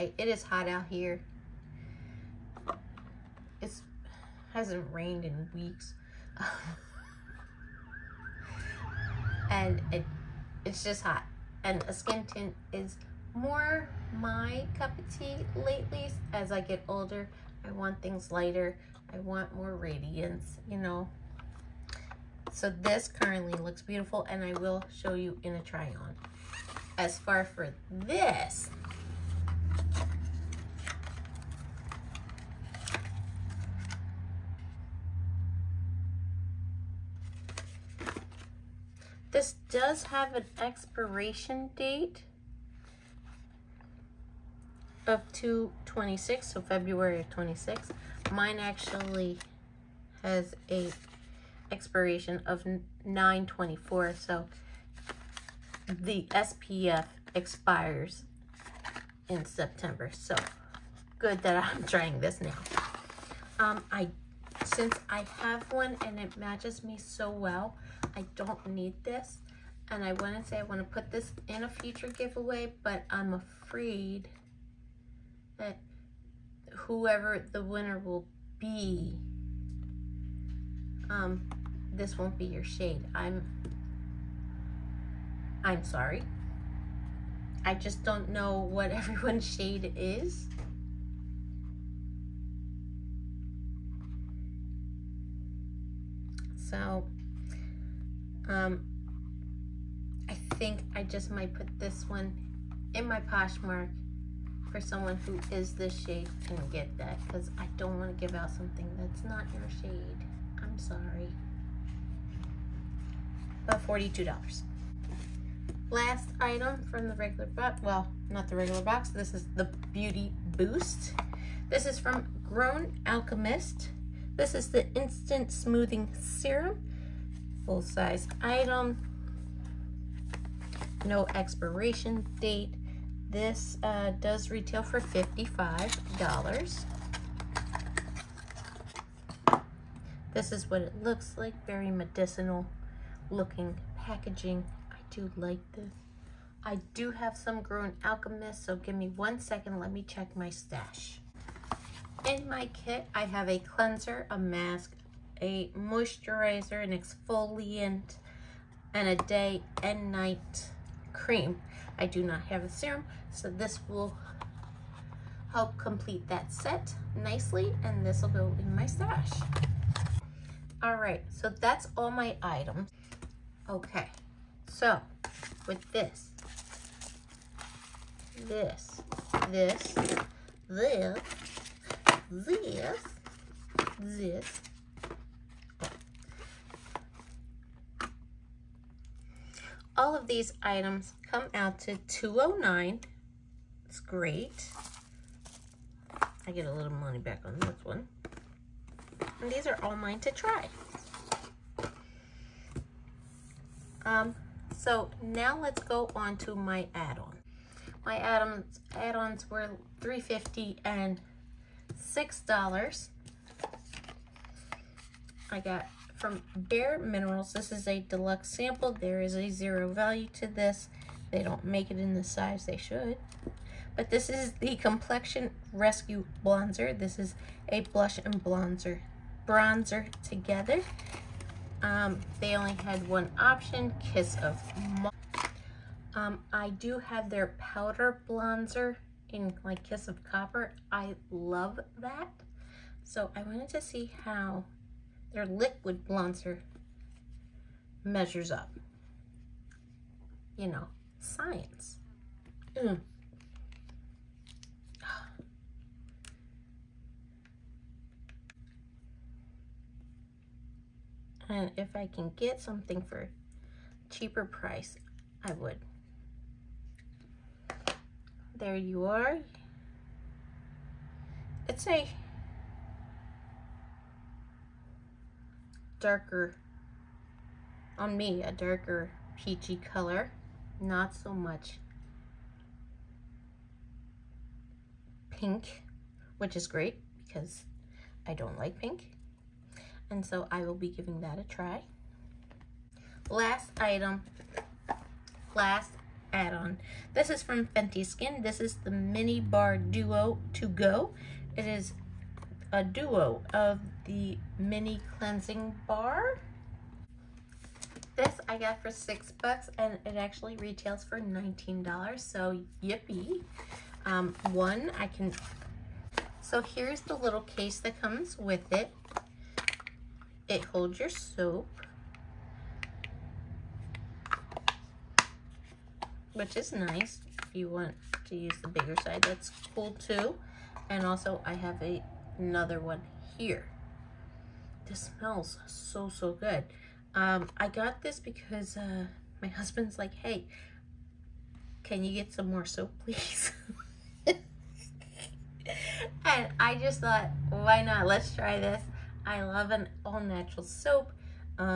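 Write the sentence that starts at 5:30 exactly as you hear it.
And also I have a another one here.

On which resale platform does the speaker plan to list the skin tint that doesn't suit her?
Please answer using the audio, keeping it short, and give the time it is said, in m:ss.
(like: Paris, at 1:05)
Poshmark, at 1:43.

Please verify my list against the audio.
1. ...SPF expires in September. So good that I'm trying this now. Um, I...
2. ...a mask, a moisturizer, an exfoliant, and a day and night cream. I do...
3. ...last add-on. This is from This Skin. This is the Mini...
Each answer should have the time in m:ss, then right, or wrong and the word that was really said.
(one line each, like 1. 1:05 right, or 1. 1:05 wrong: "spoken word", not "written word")
1. 0:56 right
2. 2:34 right
3. 4:55 wrong: "Fenty", not "This".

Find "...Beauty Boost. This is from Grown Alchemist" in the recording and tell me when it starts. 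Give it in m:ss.
1:59.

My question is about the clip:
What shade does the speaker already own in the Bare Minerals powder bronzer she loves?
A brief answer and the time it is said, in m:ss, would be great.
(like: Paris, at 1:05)
Kiss of Copper, at 3:59.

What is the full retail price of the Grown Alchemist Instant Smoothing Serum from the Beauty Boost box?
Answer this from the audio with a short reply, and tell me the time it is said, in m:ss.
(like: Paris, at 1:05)
$55, at 2:15.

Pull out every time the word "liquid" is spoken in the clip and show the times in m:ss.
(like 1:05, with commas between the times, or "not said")
4:05.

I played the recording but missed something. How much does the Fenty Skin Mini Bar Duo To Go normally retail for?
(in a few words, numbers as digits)
$19.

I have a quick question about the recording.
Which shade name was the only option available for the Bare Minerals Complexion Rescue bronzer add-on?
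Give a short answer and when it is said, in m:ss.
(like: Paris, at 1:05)
Kiss of Mauve, at 3:54.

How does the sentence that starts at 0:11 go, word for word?
And a skin tint is more my cup of tea lately as I get older.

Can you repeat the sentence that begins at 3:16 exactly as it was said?
I get a little money back on this one.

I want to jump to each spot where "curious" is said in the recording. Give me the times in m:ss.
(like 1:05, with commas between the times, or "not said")
not said.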